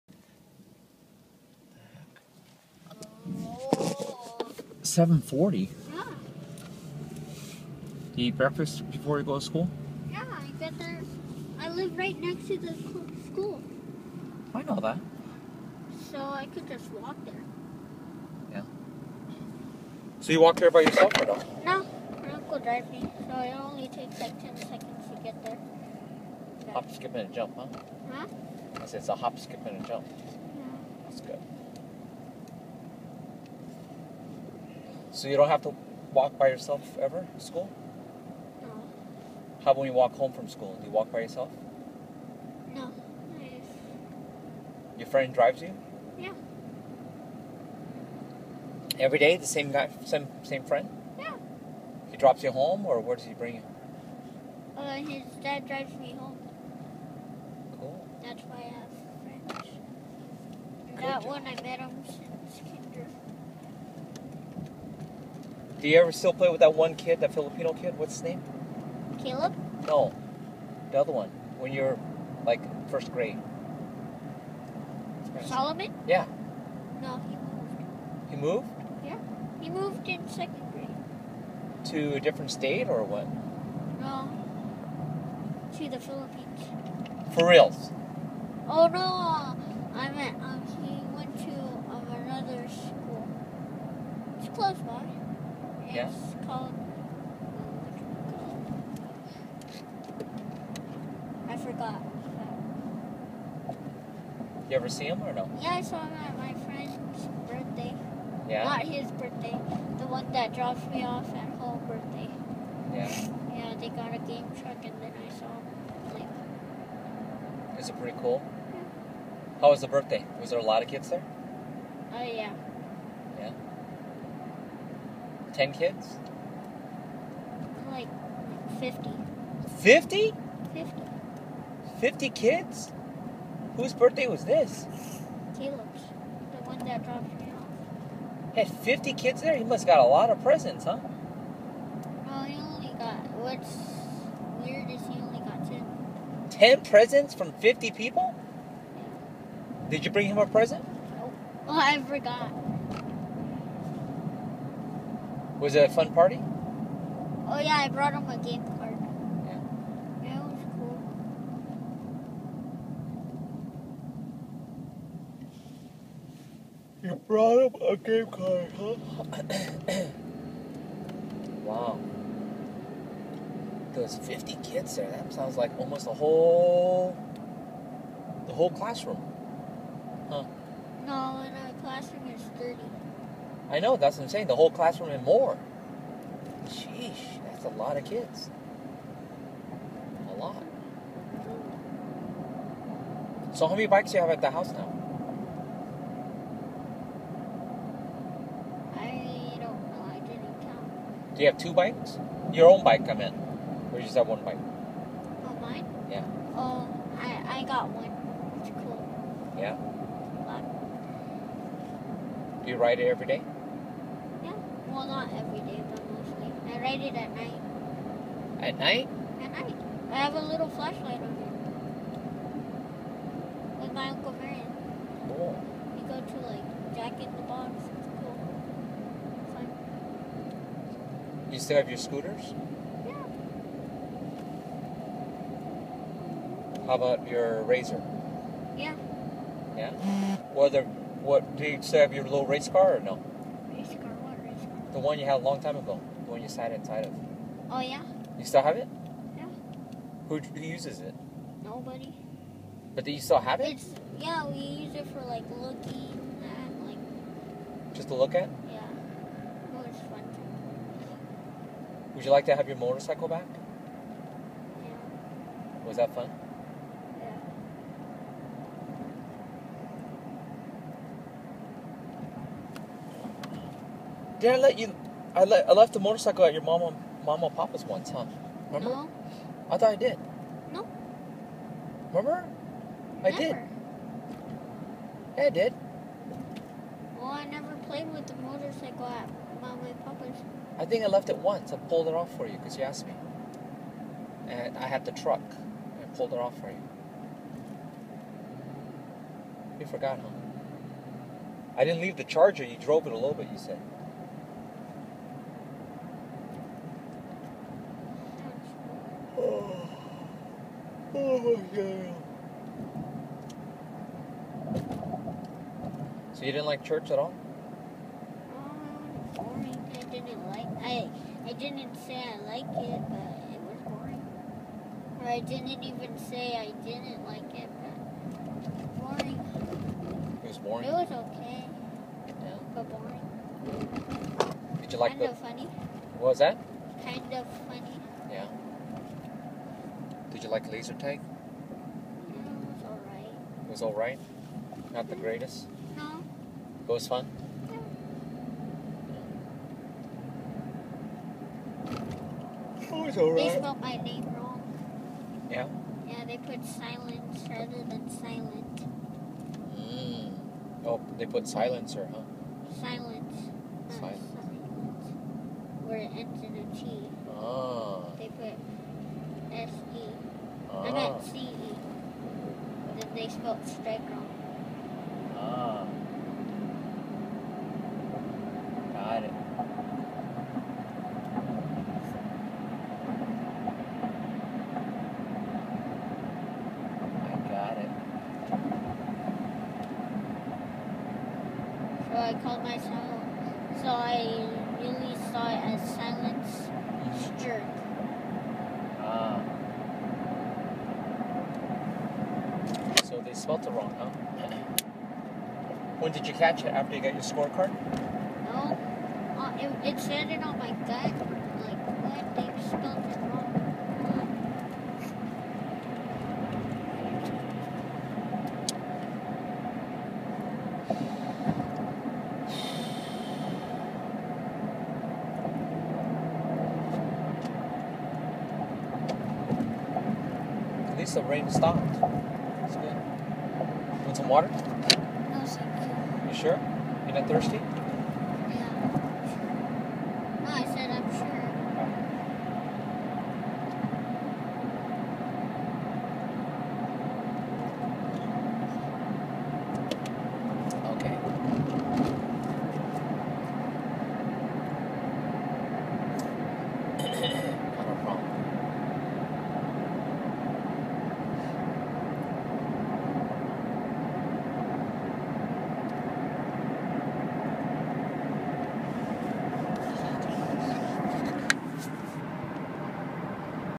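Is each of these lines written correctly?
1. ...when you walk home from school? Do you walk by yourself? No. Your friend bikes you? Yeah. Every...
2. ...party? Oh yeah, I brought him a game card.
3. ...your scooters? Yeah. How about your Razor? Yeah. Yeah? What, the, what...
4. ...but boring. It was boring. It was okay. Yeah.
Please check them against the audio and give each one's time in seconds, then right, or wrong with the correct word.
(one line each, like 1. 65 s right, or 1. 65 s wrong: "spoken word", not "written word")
1. 39 s wrong: "drives", not "bikes"
2. 156 s right
3. 231 s right
4. 327 s right.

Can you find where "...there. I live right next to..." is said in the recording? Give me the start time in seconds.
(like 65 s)
10 s.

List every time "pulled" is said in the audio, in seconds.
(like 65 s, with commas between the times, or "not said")
291 s, 296 s.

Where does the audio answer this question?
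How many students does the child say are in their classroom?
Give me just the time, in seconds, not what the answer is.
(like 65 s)
182 s.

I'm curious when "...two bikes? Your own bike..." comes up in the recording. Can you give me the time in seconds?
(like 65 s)
201 s.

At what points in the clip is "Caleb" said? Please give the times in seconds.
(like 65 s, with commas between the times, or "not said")
69 s, 135 s.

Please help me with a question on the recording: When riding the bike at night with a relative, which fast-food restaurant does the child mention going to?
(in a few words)
Jack in the Box.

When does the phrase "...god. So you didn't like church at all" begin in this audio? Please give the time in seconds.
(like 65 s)
311 s.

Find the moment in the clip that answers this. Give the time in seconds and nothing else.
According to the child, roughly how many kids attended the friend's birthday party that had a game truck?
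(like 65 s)
127 s.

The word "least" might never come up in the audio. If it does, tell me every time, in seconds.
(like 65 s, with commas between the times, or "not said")
430 s.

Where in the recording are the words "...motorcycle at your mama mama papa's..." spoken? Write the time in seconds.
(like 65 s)
275 s.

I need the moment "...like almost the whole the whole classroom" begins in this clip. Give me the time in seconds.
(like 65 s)
175 s.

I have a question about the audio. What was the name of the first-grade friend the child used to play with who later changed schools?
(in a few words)
Solomon.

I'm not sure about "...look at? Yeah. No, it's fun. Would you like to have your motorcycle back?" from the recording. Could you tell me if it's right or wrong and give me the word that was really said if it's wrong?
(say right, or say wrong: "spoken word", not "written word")
right.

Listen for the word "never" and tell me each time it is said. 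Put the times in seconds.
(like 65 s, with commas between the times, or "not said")
283 s, 287 s.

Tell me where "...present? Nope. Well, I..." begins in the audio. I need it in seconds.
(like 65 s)
150 s.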